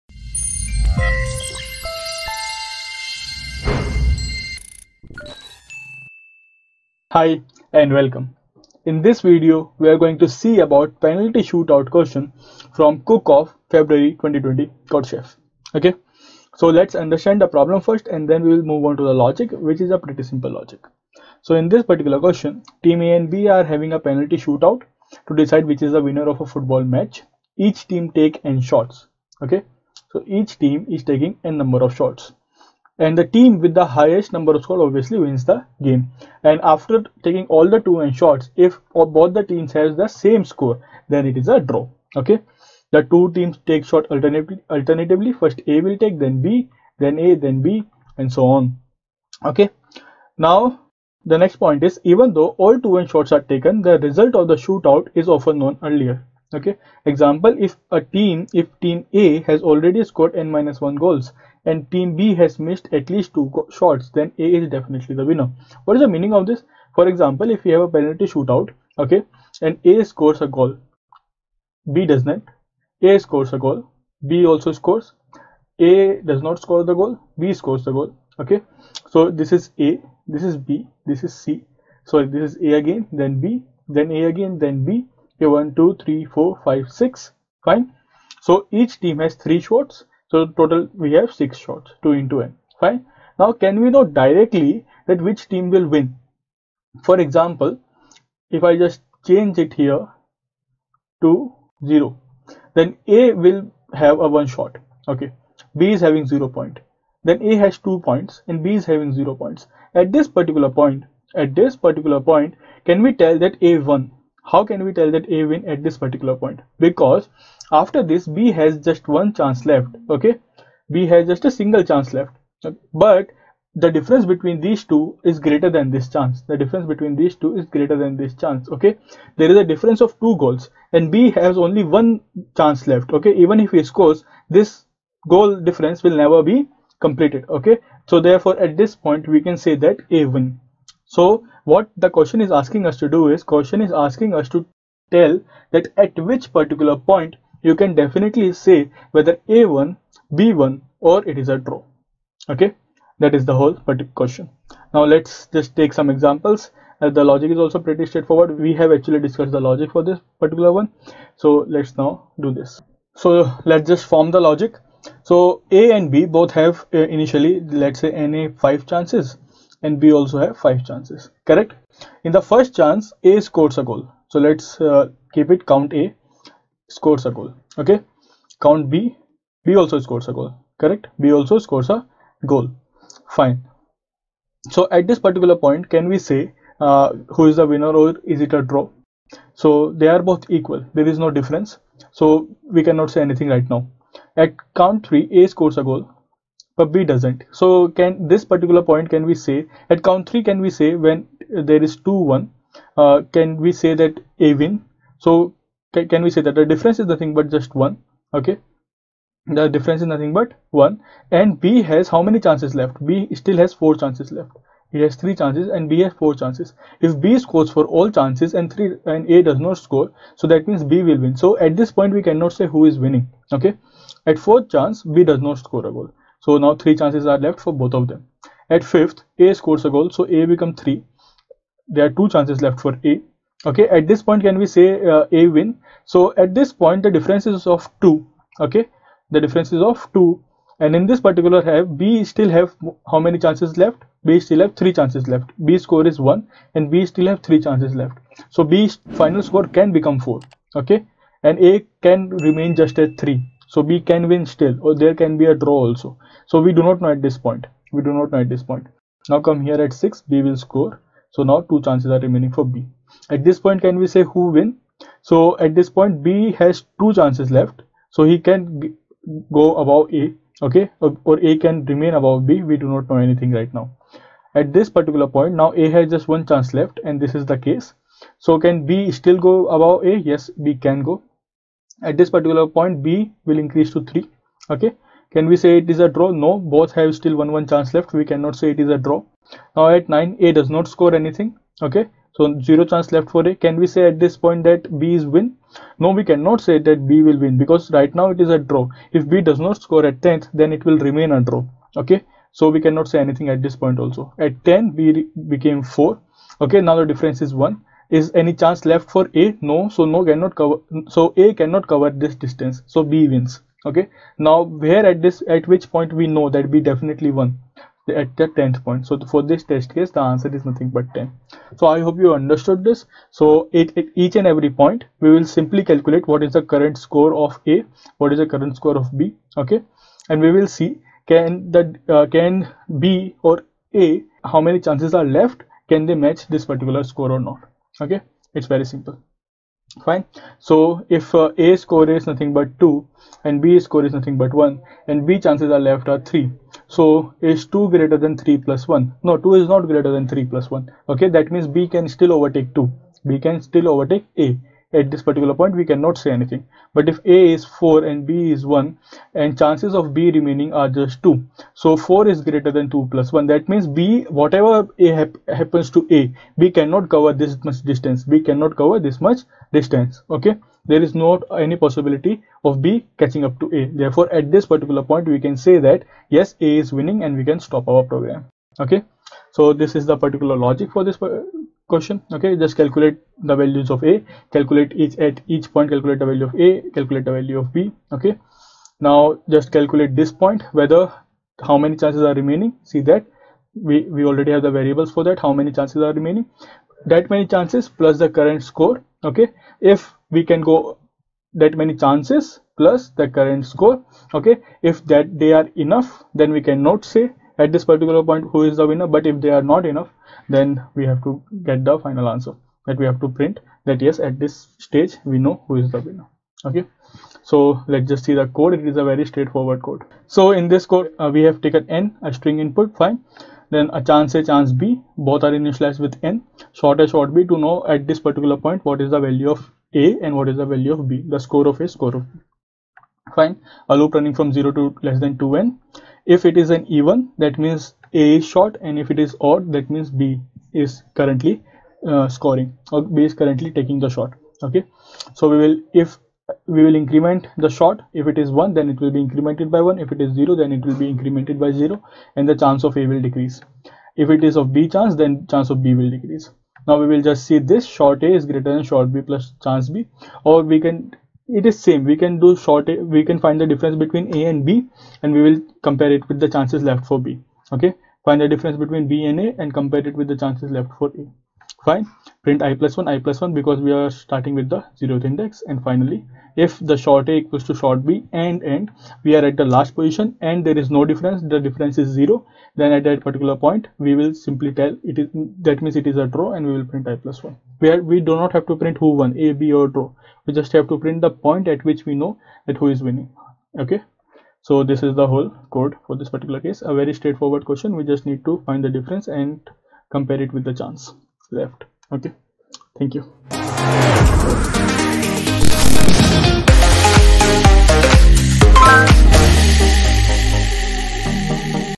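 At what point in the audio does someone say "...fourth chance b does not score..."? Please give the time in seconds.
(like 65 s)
224 s.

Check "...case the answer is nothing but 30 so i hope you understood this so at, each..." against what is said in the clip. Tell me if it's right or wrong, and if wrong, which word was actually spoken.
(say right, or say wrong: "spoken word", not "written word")
wrong: "10", not "30".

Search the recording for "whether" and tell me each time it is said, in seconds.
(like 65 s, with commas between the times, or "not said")
149 s, 390 s.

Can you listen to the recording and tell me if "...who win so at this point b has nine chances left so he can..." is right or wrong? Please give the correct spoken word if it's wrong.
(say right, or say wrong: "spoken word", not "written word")
wrong: "two", not "nine".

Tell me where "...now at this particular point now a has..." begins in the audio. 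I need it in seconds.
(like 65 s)
273 s.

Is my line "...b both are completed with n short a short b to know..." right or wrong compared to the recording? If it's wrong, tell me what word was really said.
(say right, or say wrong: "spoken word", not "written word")
wrong: "initialized", not "completed".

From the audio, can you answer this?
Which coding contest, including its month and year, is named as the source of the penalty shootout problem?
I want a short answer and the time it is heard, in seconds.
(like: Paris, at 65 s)
Cook-Off February 2020, at 13 s.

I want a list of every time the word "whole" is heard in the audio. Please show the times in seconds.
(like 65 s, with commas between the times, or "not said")
153 s, 495 s.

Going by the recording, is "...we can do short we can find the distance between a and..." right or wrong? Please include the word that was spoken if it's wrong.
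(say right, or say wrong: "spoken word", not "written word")
wrong: "difference", not "distance".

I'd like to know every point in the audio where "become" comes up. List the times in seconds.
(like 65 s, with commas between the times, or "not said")
230 s, 249 s.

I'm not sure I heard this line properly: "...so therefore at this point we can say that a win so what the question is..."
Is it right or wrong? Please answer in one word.
right.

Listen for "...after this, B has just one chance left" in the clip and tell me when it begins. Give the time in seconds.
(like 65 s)
117 s.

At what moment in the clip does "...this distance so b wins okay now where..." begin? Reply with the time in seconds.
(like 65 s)
312 s.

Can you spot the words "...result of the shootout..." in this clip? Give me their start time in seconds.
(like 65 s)
54 s.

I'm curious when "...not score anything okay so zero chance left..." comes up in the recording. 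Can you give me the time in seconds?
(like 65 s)
290 s.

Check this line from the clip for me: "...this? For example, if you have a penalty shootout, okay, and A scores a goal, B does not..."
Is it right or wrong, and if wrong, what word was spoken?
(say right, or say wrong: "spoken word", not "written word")
right.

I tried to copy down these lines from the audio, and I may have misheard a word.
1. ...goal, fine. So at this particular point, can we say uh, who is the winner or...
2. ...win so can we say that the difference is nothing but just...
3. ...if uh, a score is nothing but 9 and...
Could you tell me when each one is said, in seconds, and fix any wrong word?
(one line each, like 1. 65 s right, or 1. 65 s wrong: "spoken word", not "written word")
1. 182 s right
2. 204 s right
3. 341 s wrong: "2", not "9".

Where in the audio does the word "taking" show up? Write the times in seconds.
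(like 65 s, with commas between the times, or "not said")
31 s, 37 s, 443 s.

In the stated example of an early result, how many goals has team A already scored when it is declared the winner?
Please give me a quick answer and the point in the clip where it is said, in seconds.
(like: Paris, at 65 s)
n minus 1, at 60 s.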